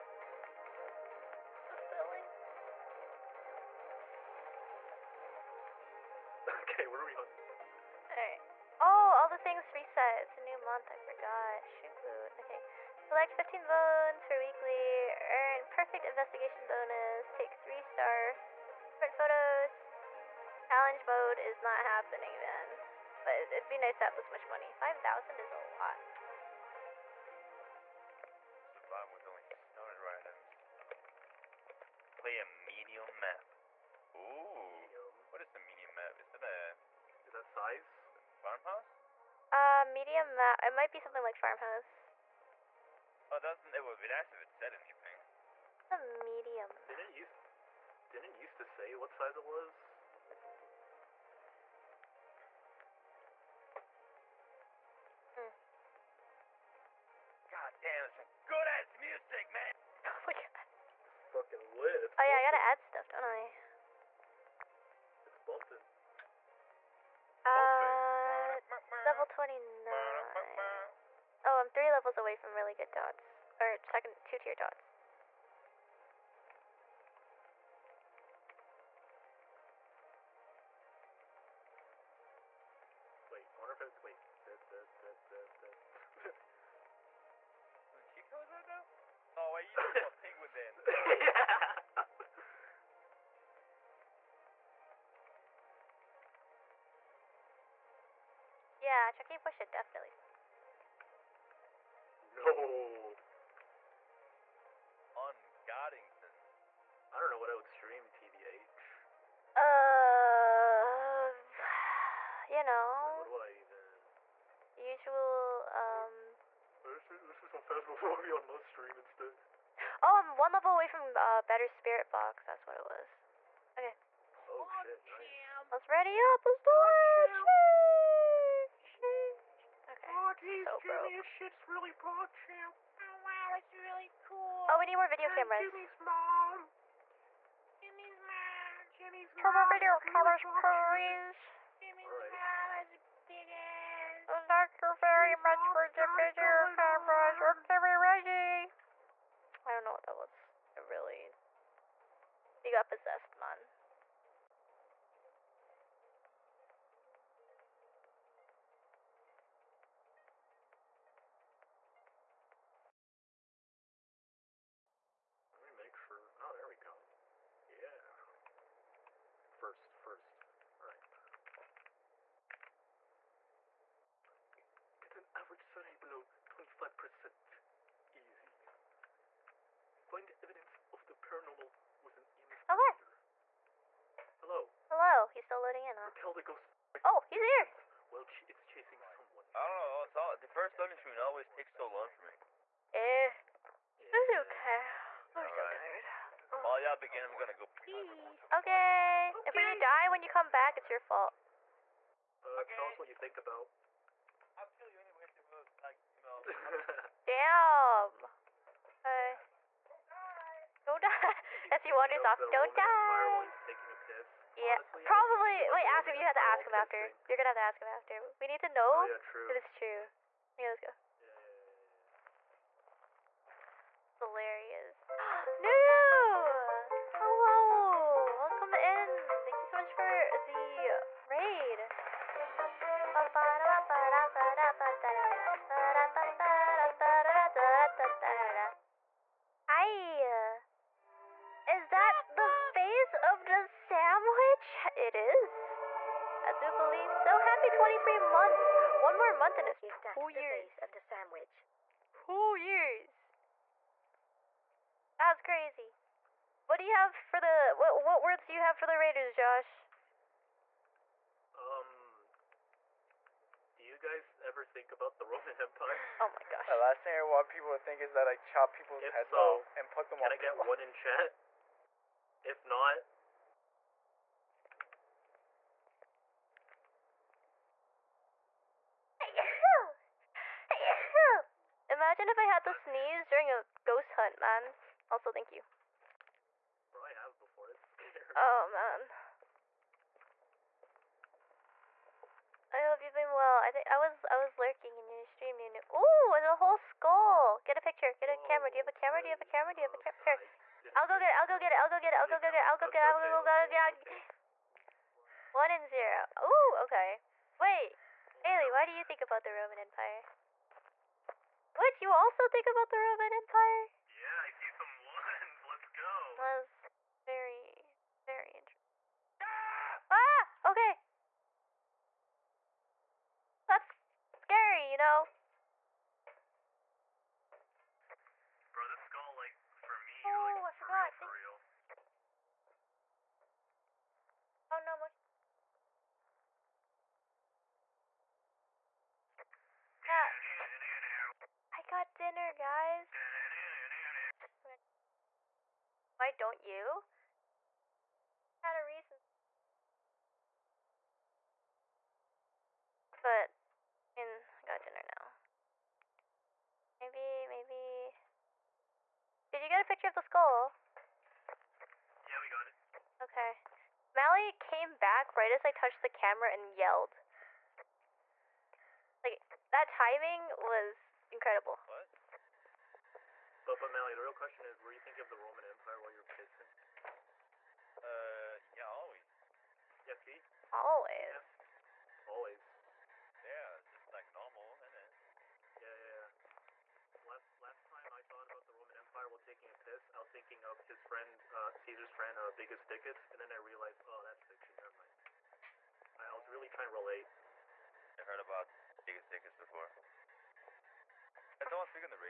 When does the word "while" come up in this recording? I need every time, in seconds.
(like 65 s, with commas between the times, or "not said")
196 s, 375 s, 389 s.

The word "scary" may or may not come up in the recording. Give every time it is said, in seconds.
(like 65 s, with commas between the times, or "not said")
287 s, 324 s.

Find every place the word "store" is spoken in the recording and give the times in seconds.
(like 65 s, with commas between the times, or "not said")
not said.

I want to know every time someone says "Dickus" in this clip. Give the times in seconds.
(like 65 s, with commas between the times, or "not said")
392 s, 399 s.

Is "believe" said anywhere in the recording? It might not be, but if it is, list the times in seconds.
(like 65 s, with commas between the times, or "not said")
246 s.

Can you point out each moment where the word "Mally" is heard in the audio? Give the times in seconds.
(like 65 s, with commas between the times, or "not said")
364 s, 373 s.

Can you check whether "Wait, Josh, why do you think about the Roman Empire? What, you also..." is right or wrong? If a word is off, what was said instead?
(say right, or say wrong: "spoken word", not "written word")
wrong: "Ailey", not "Josh".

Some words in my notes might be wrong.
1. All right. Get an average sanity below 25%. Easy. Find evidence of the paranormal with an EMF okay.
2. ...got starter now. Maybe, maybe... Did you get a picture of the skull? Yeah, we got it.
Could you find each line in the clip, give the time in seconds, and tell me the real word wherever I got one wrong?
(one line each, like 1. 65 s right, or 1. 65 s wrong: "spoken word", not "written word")
1. 170 s right
2. 354 s wrong: "dinner", not "starter".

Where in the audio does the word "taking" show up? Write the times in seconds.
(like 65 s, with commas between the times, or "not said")
213 s, 389 s.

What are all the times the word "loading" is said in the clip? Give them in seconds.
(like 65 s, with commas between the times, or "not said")
185 s, 190 s.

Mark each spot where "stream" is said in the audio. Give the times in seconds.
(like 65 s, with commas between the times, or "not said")
107 s, 118 s, 295 s.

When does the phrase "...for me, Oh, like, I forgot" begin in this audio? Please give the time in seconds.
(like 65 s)
329 s.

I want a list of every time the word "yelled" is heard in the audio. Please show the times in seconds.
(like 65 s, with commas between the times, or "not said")
366 s.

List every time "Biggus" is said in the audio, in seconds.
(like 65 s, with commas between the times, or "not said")
392 s, 399 s.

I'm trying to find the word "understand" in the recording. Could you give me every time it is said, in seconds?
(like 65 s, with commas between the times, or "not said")
not said.